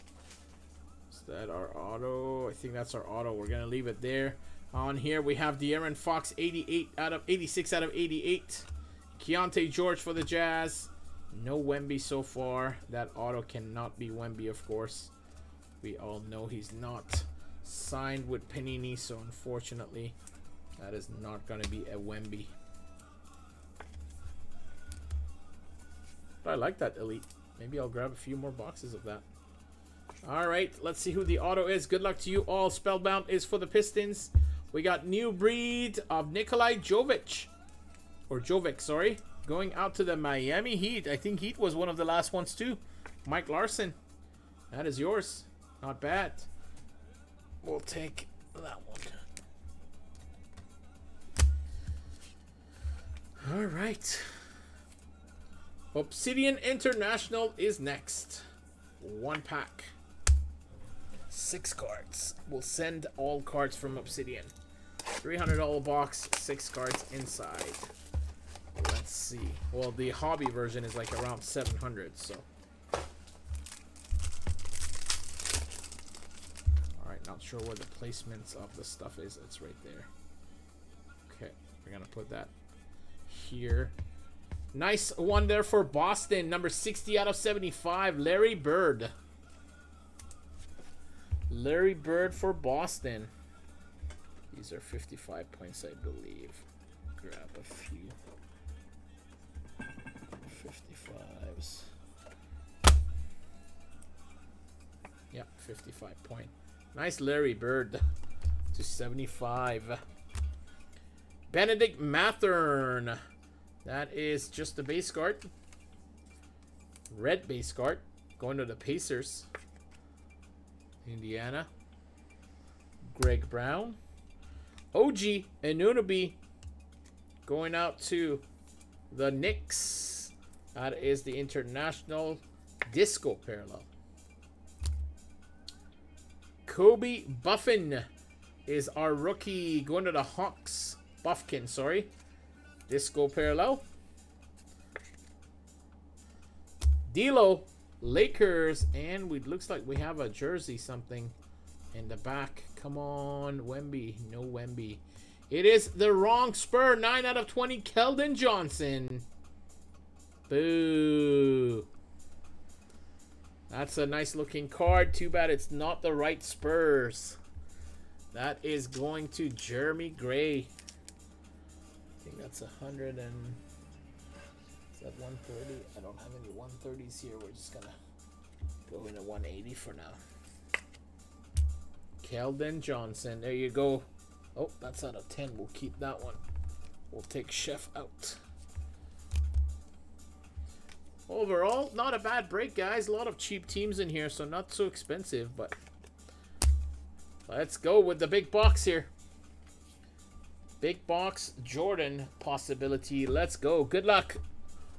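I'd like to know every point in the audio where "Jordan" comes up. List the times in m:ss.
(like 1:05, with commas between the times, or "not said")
3:21.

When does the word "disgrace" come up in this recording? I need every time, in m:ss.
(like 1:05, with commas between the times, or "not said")
not said.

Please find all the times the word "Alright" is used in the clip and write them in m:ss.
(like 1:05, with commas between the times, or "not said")
0:30, 1:17.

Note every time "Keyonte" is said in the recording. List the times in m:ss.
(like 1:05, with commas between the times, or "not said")
0:09.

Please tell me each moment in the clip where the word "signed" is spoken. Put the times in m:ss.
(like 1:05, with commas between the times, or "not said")
0:17.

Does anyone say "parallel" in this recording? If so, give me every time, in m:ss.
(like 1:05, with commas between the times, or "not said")
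2:13, 2:23.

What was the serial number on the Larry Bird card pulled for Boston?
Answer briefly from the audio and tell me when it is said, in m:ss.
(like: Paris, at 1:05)
60 out of 75, at 1:26.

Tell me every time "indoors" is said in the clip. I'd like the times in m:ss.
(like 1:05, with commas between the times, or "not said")
not said.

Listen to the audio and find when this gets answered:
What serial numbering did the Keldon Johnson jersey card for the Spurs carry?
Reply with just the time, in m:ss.
2:36.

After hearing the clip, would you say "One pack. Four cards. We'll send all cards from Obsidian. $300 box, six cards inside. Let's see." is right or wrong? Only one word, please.
wrong.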